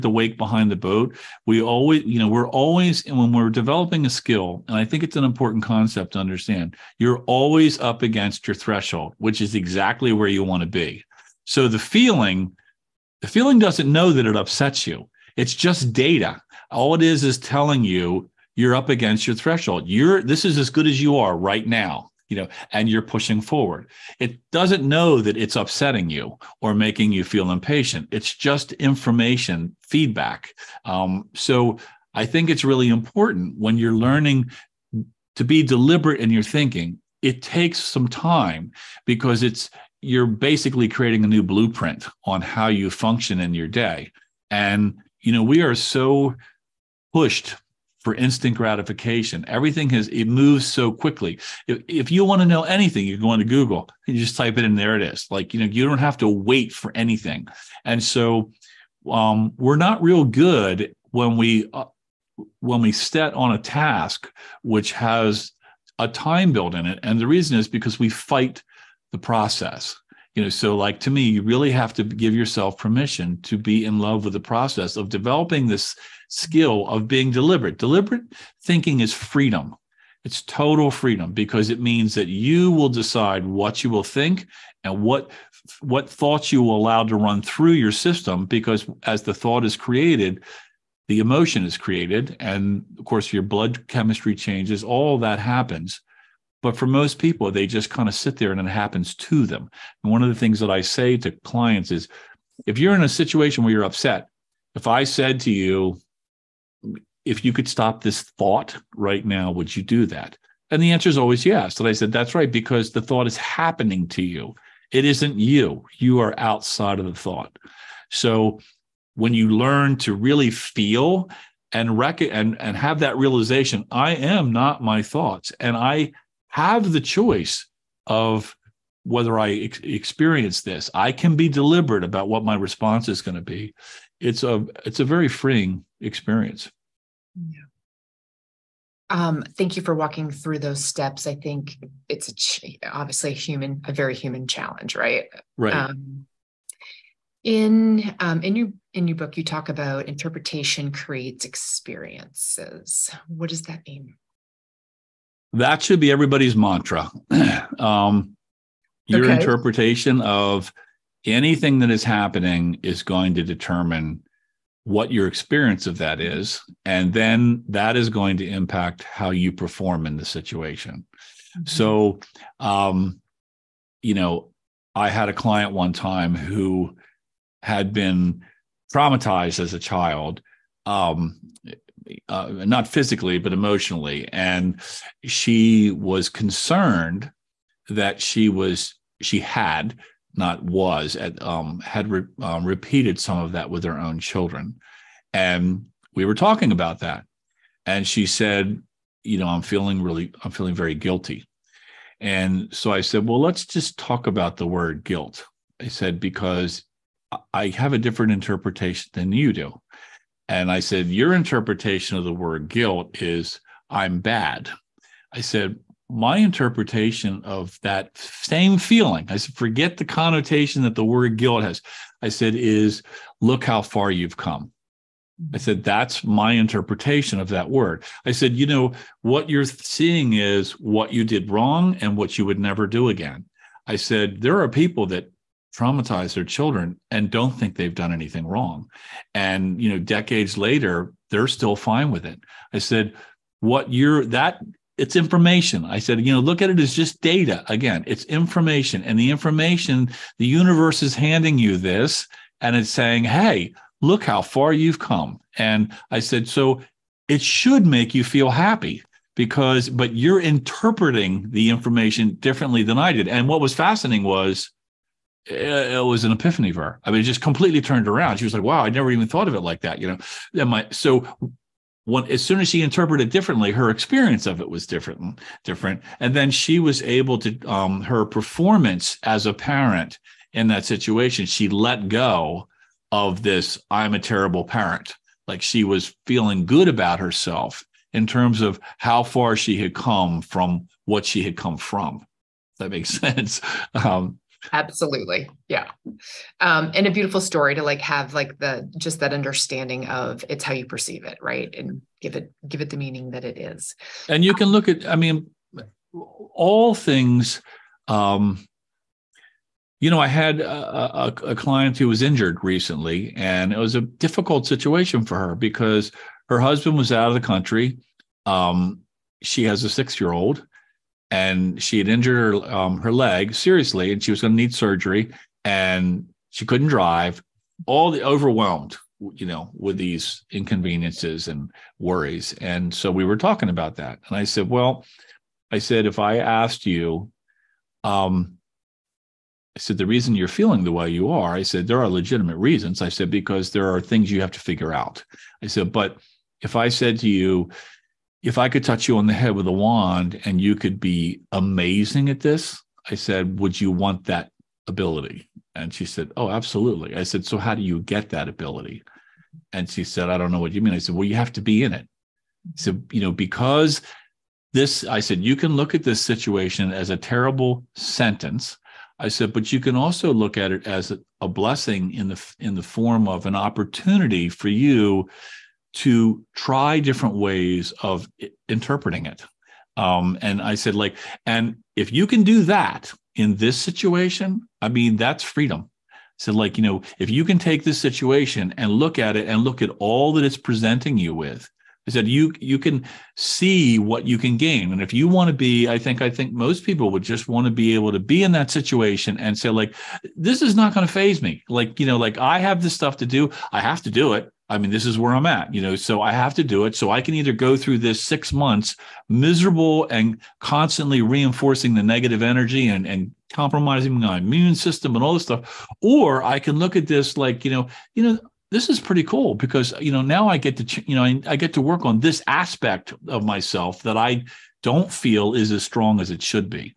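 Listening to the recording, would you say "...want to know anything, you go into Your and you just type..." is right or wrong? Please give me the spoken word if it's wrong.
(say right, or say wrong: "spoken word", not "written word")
wrong: "Google", not "Your".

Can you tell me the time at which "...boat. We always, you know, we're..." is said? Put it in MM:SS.
00:00.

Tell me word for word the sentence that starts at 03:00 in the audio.
Um, uh, not physically, but emotionally.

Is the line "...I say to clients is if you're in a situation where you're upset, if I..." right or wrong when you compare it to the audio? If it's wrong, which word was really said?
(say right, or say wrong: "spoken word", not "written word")
right.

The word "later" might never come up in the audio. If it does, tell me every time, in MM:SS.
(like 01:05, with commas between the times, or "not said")
04:00.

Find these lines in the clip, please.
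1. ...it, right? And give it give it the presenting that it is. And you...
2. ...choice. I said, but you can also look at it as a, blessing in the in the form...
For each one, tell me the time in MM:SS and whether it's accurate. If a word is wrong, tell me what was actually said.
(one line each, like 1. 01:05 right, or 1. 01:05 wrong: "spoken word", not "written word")
1. 05:01 wrong: "meaning", not "presenting"
2. 06:07 wrong: "sentence", not "choice".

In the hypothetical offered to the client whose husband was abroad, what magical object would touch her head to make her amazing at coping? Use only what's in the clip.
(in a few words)
A wand.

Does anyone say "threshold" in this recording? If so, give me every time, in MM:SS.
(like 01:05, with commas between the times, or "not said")
00:08, 00:19.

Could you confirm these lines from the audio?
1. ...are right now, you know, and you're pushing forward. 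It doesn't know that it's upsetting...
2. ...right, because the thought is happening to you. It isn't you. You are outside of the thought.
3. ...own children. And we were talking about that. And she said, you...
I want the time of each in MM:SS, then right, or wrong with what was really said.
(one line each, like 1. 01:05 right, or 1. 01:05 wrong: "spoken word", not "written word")
1. 00:21 right
2. 01:52 right
3. 03:13 right.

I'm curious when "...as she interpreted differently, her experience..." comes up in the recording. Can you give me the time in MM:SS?
04:32.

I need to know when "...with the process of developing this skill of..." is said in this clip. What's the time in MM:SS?
01:14.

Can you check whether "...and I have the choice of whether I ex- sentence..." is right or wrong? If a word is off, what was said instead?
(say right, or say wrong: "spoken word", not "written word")
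wrong: "experience", not "sentence".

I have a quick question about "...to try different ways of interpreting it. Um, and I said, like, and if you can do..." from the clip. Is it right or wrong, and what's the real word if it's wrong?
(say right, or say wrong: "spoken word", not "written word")
right.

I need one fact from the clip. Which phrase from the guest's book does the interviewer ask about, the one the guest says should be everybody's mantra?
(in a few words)
Interpretation creates experiences.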